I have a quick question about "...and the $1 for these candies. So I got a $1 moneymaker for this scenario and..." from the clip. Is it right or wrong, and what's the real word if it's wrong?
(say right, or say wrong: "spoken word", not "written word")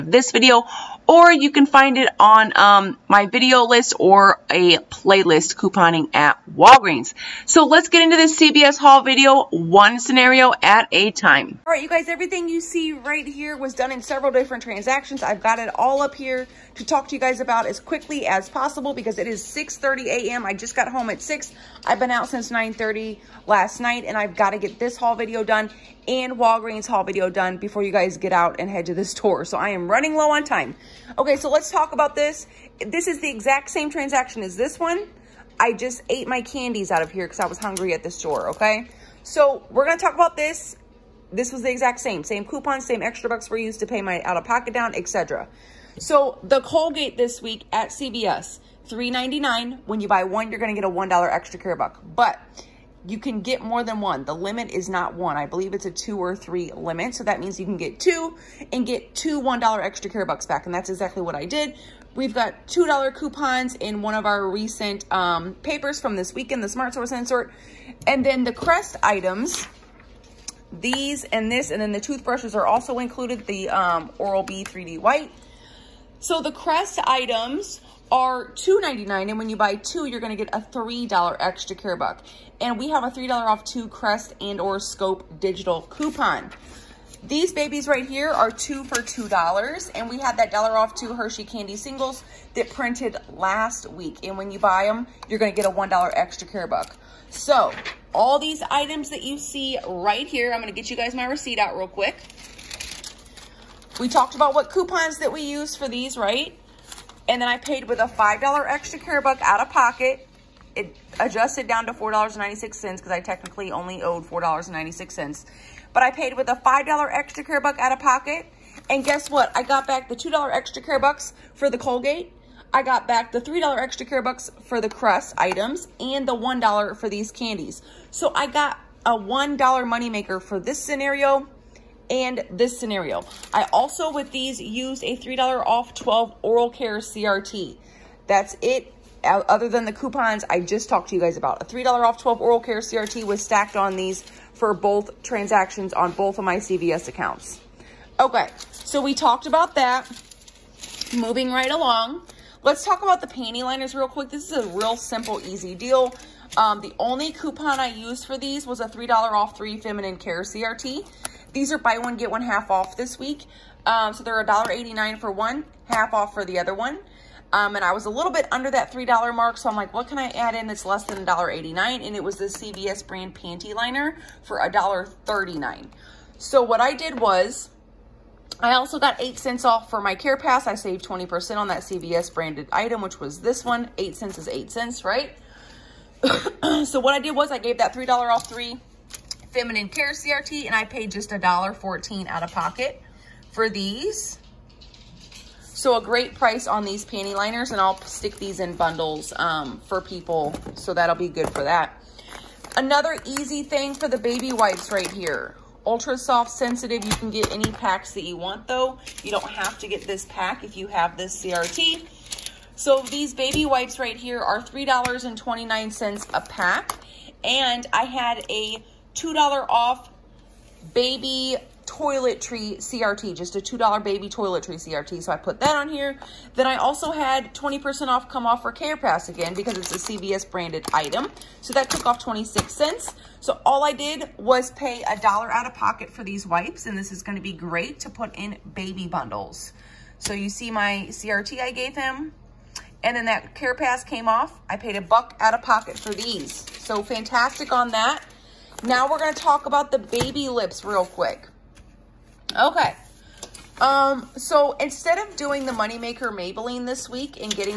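right.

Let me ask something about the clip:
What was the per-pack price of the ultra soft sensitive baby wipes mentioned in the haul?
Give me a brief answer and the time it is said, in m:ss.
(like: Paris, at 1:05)
$3.29, at 3:34.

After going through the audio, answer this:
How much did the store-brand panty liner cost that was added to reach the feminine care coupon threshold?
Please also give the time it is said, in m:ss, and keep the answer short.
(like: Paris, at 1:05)
$1.39, at 2:54.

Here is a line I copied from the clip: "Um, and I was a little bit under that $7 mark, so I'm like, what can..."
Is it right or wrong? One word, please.
wrong.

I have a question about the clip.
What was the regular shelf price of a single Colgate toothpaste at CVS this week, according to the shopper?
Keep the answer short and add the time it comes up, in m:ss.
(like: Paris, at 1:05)
$3.99, at 0:48.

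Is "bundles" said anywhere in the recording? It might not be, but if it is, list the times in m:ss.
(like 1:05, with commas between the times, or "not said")
3:18, 3:59.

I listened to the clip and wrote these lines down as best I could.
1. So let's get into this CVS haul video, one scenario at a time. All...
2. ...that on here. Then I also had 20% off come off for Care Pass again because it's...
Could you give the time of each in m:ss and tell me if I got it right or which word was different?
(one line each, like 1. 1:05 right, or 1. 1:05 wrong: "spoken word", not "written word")
1. 0:07 right
2. 3:45 right.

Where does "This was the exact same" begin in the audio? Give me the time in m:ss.
0:41.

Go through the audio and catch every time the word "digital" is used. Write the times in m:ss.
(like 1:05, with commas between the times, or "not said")
1:25.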